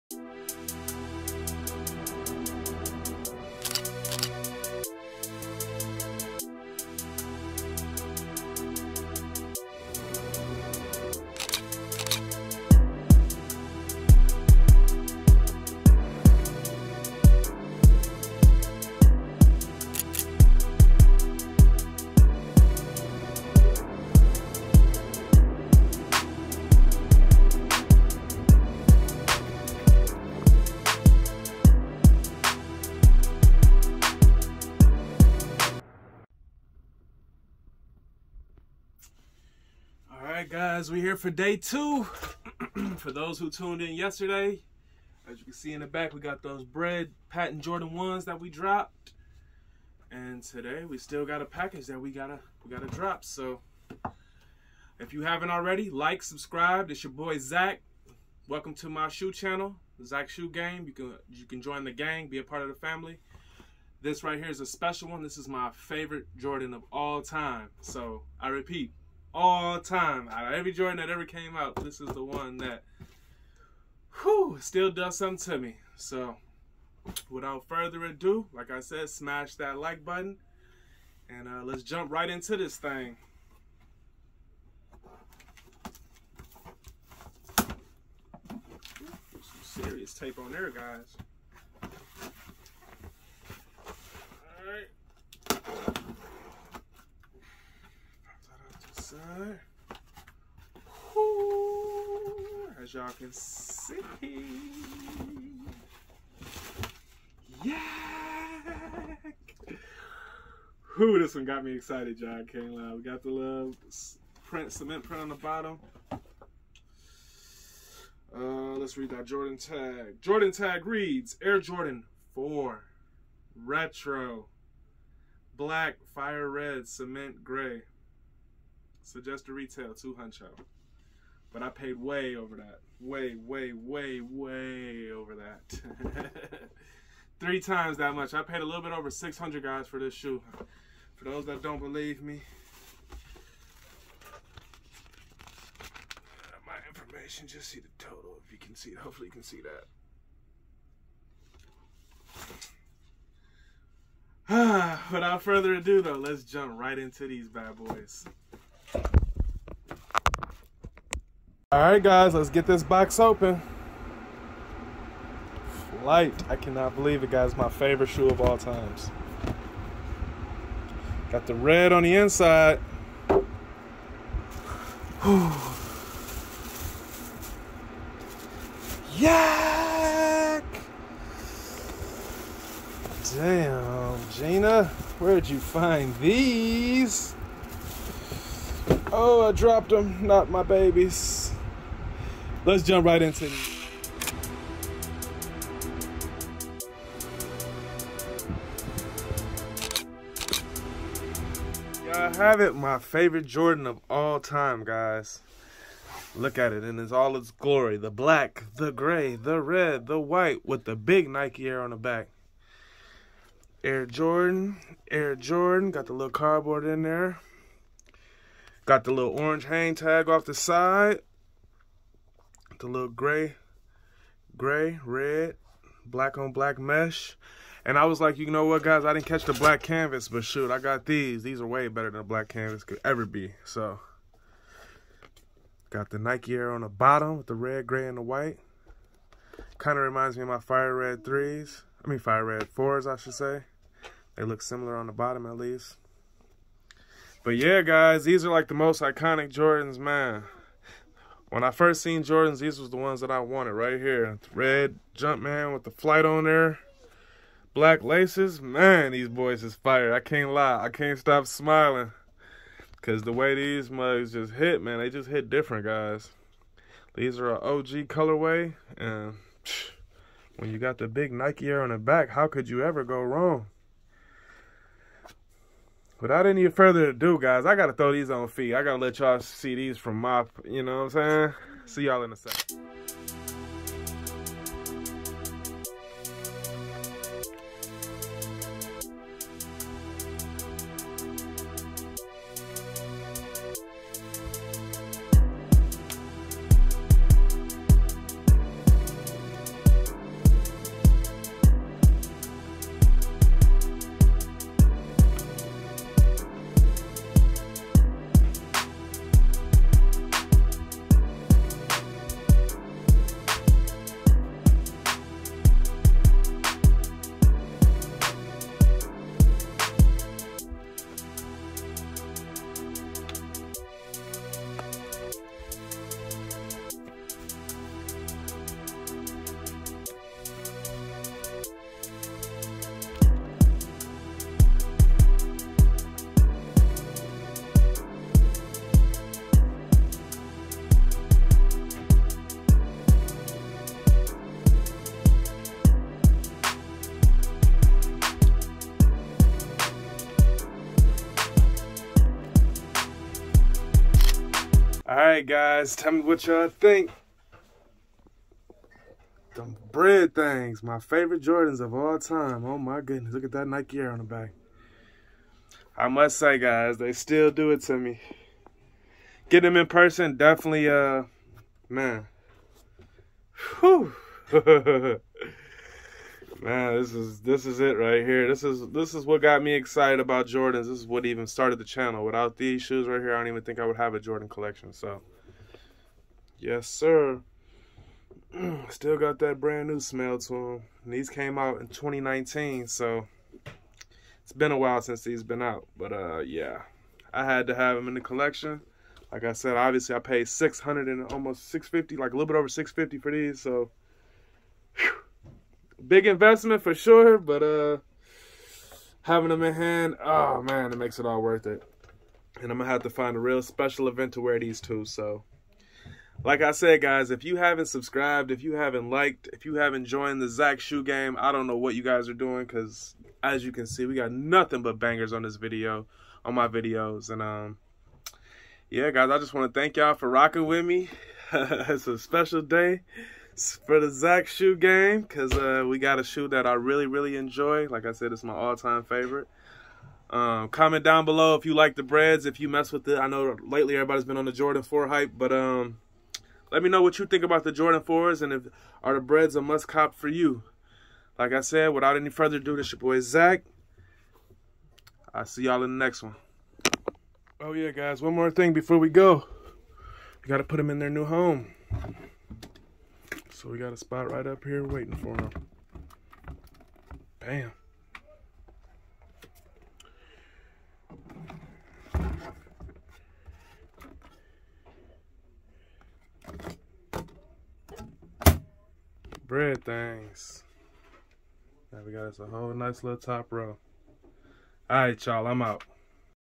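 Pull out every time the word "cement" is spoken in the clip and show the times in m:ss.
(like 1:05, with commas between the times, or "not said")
1:54, 2:06.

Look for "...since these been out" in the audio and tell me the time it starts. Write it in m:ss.
6:35.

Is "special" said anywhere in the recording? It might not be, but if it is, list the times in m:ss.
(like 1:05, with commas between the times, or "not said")
1:04, 6:53, 7:12.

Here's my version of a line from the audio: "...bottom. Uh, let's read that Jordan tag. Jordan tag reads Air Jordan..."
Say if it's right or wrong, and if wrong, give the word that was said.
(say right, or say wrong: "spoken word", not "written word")
right.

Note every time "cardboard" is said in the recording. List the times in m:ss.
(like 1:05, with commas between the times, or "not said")
3:36.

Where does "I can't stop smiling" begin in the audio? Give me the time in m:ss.
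4:20.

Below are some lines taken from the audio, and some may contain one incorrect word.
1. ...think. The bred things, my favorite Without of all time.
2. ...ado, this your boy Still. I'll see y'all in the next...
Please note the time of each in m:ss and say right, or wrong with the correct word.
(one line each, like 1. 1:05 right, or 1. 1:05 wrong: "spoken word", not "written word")
1. 5:56 wrong: "Jordans", not "Without"
2. 7:32 wrong: "Zach", not "Still".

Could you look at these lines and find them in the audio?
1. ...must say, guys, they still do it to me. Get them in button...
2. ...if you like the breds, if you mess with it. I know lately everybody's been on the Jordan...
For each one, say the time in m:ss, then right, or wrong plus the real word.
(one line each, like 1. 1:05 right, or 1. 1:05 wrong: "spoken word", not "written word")
1. 6:06 wrong: "person", not "button"
2. 7:21 right.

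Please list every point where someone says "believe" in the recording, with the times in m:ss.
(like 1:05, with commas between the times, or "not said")
2:21, 2:46.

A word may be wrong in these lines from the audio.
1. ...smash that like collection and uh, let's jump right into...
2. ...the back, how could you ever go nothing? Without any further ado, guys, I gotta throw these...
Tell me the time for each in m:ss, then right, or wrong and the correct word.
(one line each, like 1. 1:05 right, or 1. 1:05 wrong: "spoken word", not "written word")
1. 1:19 wrong: "button", not "collection"
2. 4:31 wrong: "wrong", not "nothing".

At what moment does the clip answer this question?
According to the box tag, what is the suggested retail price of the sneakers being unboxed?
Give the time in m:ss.
2:09.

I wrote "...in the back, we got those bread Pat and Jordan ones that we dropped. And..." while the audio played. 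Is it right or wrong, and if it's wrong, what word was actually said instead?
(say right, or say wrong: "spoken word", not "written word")
right.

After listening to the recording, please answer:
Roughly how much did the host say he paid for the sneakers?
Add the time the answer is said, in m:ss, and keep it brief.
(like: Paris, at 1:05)
a little bit over 600, at 2:18.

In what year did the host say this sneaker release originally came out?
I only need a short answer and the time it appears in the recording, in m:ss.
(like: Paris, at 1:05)
2019, at 6:31.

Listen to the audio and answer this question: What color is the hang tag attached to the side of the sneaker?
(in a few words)
orange.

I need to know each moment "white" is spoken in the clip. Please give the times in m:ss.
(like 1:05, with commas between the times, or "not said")
3:30, 3:58.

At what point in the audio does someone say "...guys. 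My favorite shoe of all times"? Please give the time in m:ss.
2:47.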